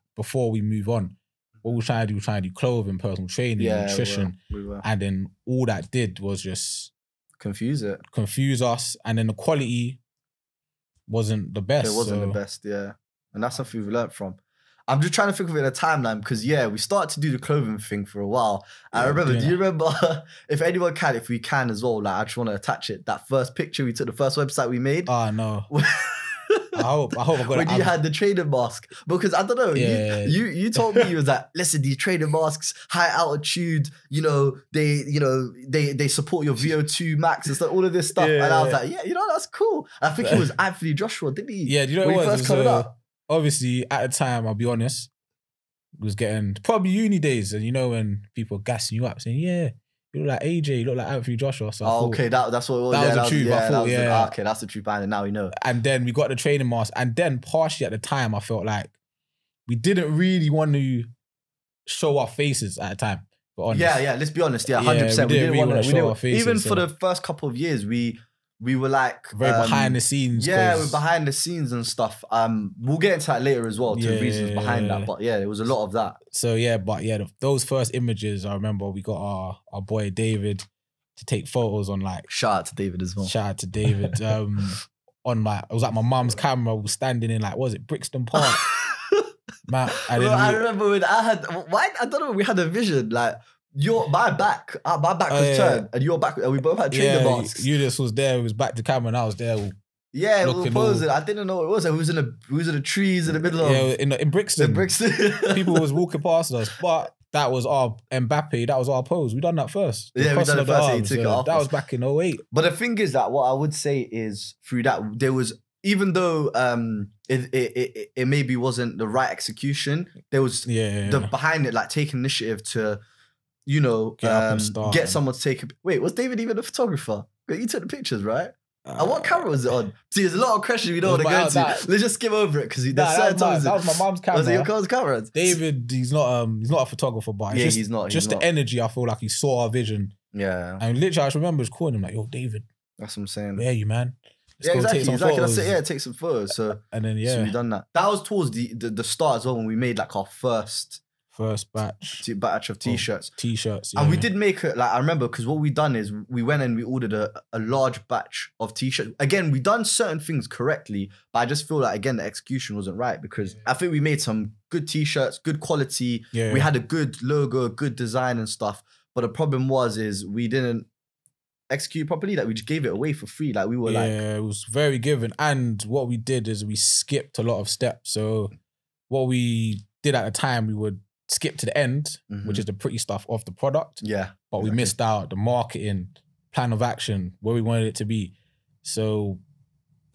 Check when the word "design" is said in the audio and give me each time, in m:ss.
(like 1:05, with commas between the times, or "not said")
2:47.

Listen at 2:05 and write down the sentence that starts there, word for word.
Wait, was David even a photographer?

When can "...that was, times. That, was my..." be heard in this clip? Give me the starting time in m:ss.
2:13.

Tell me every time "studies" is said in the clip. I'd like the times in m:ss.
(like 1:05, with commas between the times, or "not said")
not said.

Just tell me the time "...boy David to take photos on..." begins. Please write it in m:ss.
1:19.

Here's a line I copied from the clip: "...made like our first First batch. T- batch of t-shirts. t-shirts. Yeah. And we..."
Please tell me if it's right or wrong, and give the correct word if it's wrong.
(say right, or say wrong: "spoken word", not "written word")
right.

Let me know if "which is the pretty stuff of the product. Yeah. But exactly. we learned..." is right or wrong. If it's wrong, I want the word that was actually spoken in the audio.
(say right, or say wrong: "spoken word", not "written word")
wrong: "missed", not "learned".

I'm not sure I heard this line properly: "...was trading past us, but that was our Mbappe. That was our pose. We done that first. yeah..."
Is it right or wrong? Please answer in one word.
wrong.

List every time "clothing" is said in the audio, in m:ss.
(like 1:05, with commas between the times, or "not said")
0:02, 0:17.